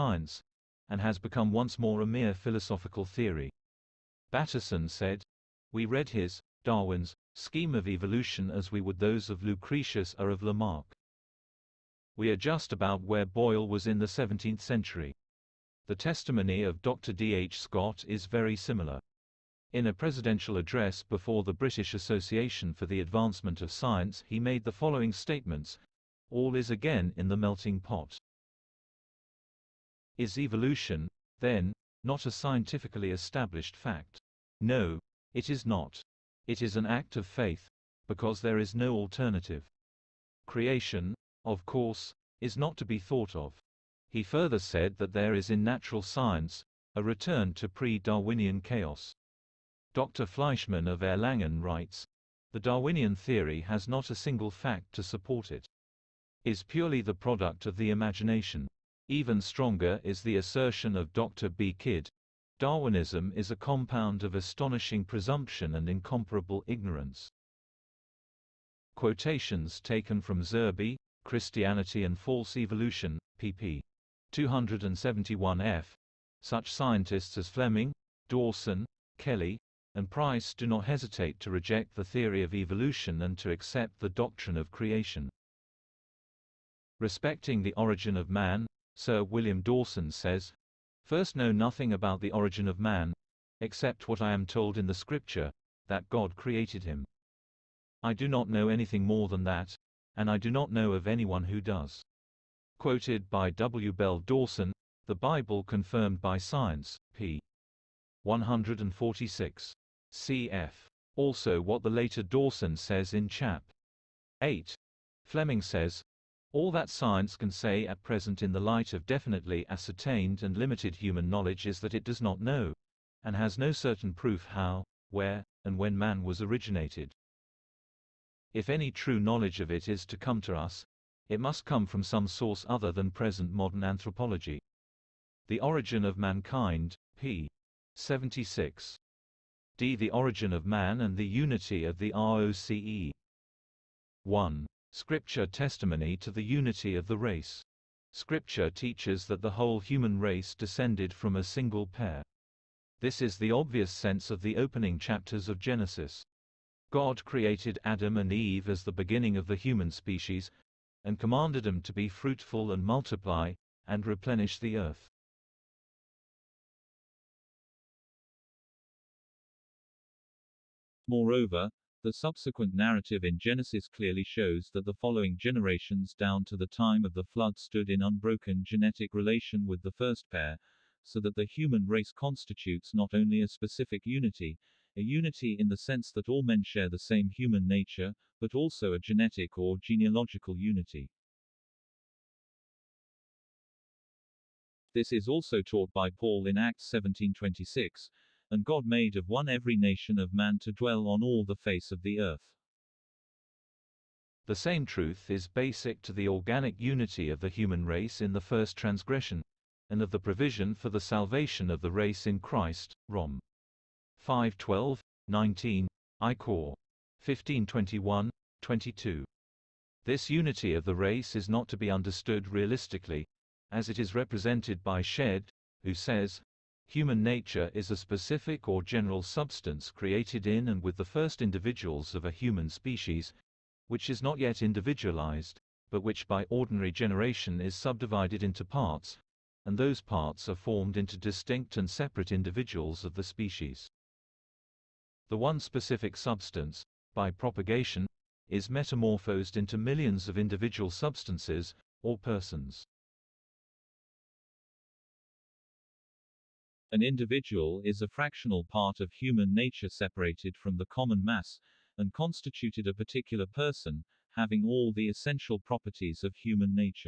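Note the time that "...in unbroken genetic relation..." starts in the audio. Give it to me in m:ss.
2:57.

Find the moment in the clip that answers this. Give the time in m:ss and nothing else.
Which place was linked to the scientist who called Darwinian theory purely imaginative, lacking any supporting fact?
0:51.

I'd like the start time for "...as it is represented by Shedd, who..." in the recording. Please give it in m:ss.
3:43.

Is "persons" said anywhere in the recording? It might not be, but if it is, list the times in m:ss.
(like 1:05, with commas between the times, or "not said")
4:12, 4:23.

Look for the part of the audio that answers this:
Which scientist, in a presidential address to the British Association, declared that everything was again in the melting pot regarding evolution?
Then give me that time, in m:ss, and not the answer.
0:16.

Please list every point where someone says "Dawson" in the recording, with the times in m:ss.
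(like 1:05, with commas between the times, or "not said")
1:18, 1:29, 1:44, 1:52.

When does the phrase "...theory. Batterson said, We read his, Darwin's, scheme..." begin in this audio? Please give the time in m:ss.
0:03.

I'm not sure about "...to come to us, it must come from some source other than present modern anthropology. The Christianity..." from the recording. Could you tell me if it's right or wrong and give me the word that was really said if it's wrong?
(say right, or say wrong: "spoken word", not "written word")
wrong: "Origin", not "Christianity".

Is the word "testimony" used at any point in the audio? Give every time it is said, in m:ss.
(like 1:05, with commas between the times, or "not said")
0:15, 2:25.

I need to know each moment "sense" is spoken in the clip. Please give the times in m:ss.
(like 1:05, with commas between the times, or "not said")
2:33, 3:05.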